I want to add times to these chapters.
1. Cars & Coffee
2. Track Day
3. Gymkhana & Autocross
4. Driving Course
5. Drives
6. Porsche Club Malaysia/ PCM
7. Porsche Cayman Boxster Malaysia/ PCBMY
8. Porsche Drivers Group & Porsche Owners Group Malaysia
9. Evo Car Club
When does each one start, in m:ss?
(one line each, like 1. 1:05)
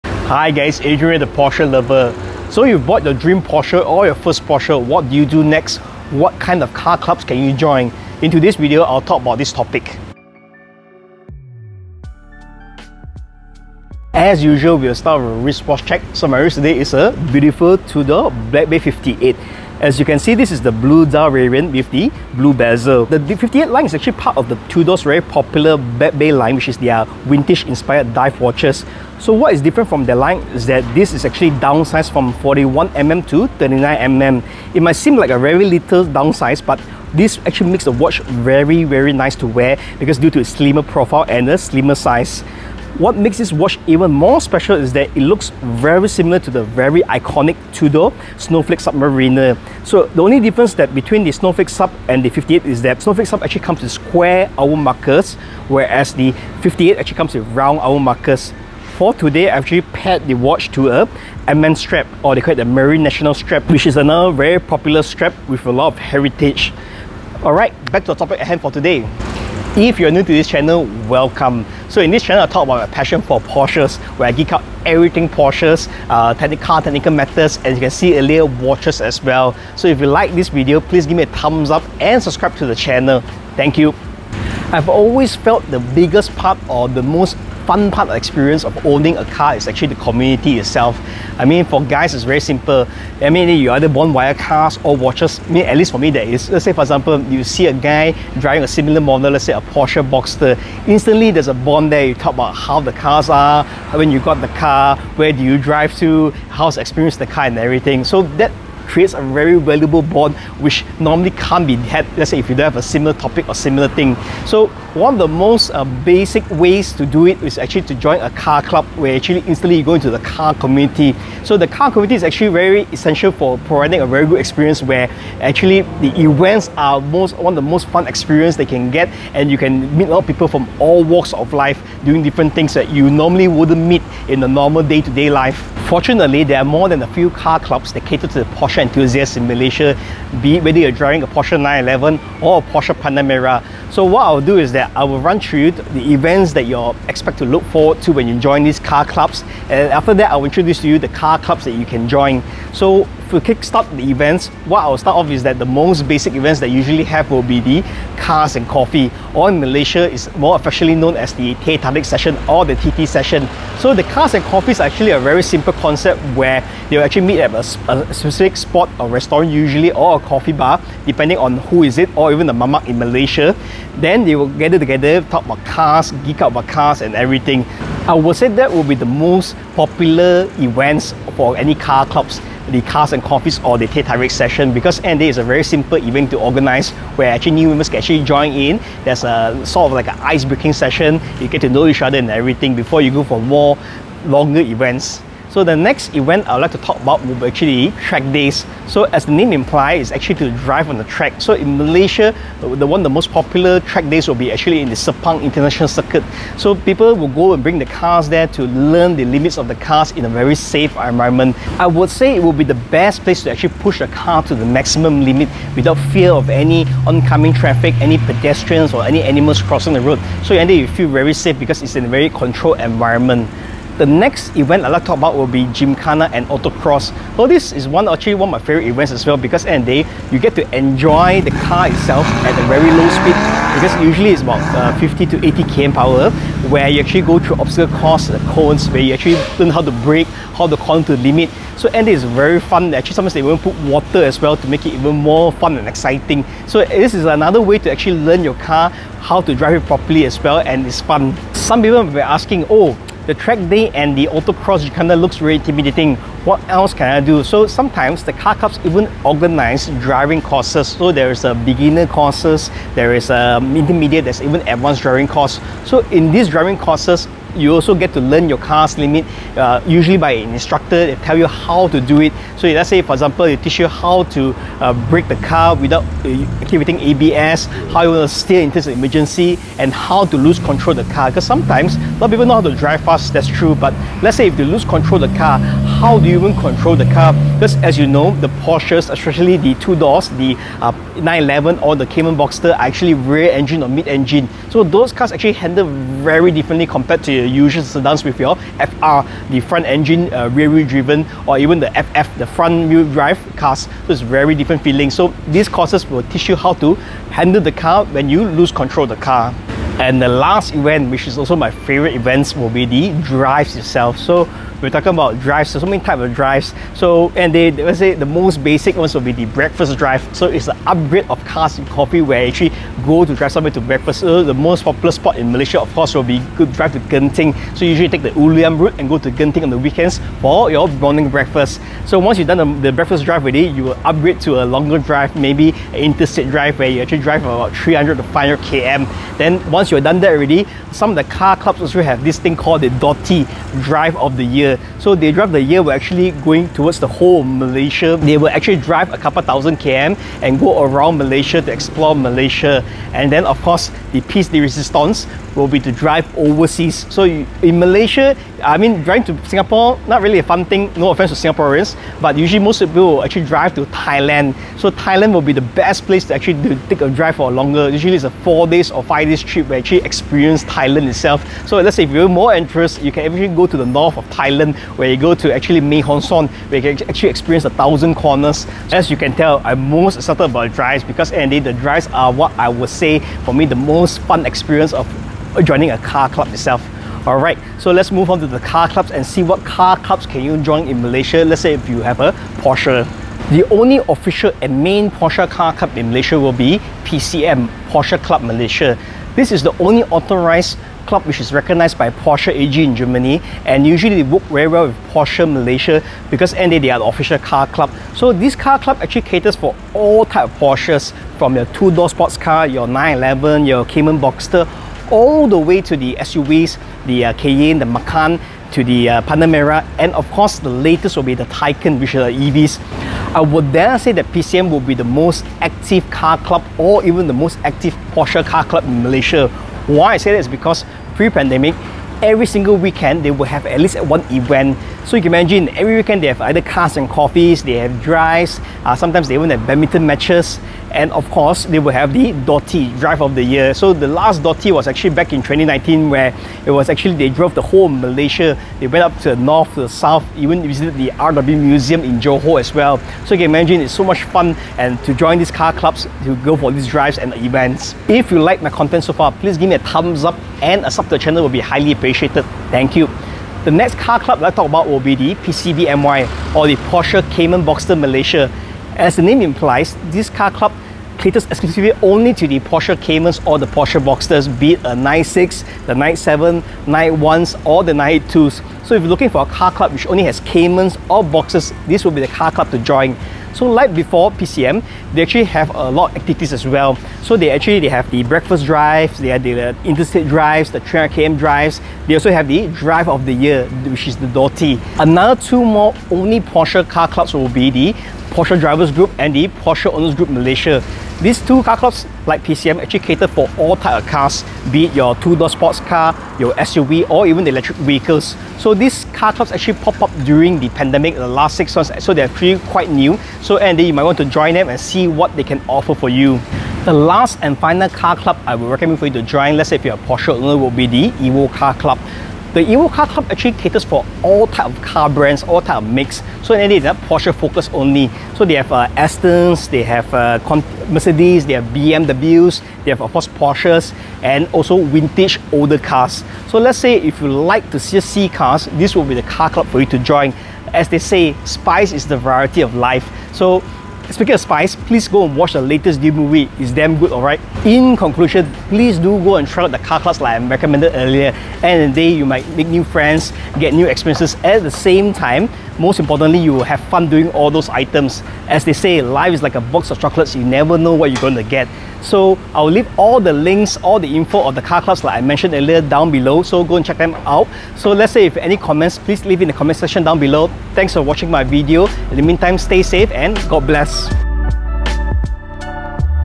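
1. 2:33
2. 3:16
3. 3:43
4. 4:11
5. 5:10
6. 6:33
7. 7:43
8. 8:15
9. 8:36.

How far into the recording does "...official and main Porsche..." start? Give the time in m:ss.
6:34.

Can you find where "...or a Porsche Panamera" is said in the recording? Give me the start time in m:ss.
2:22.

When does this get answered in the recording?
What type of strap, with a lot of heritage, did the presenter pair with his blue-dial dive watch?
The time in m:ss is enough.
1:02.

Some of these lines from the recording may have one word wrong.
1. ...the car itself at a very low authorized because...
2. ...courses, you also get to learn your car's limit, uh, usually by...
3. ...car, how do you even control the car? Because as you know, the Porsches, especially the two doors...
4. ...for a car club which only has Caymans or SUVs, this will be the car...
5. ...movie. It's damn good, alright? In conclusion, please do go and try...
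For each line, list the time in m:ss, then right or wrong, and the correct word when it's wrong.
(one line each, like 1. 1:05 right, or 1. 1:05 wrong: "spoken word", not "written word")
1. 3:51 wrong: "speed", not "authorized"
2. 4:26 right
3. 4:45 right
4. 7:59 wrong: "Boxsters", not "SUVs"
5. 9:06 right.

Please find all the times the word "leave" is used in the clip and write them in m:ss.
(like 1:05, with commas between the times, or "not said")
9:22, 9:29.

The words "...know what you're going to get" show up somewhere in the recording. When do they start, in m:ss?
9:20.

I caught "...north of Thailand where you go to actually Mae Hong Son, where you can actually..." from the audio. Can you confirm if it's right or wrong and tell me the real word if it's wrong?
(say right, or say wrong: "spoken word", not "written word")
right.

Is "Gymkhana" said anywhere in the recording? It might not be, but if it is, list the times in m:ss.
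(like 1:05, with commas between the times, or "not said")
3:45.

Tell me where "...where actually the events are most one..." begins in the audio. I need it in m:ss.
2:04.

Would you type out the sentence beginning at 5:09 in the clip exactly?
And the last event, which is also my favorite events, will be the drives itself.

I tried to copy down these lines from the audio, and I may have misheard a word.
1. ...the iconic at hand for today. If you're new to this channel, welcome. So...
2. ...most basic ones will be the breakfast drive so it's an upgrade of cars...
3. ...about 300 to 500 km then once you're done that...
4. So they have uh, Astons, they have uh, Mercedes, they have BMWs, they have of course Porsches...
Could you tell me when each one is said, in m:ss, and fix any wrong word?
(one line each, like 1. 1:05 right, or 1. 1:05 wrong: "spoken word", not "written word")
1. 1:08 wrong: "topic", not "iconic"
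2. 5:18 right
3. 5:37 right
4. 8:48 right.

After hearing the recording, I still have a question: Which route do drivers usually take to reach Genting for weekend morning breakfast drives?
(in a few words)
Ulu Yam route.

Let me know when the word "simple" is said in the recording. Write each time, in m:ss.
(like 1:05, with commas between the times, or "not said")
1:32, 2:45, 3:05.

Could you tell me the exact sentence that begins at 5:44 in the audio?
So they drive the year were actually going towards the whole Malaysia.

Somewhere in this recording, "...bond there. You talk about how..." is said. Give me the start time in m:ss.
1:41.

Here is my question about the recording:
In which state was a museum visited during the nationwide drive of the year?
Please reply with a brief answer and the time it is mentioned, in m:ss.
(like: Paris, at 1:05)
Johor, at 7:32.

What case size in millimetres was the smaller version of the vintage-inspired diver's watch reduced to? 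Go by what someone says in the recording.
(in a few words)
39mm.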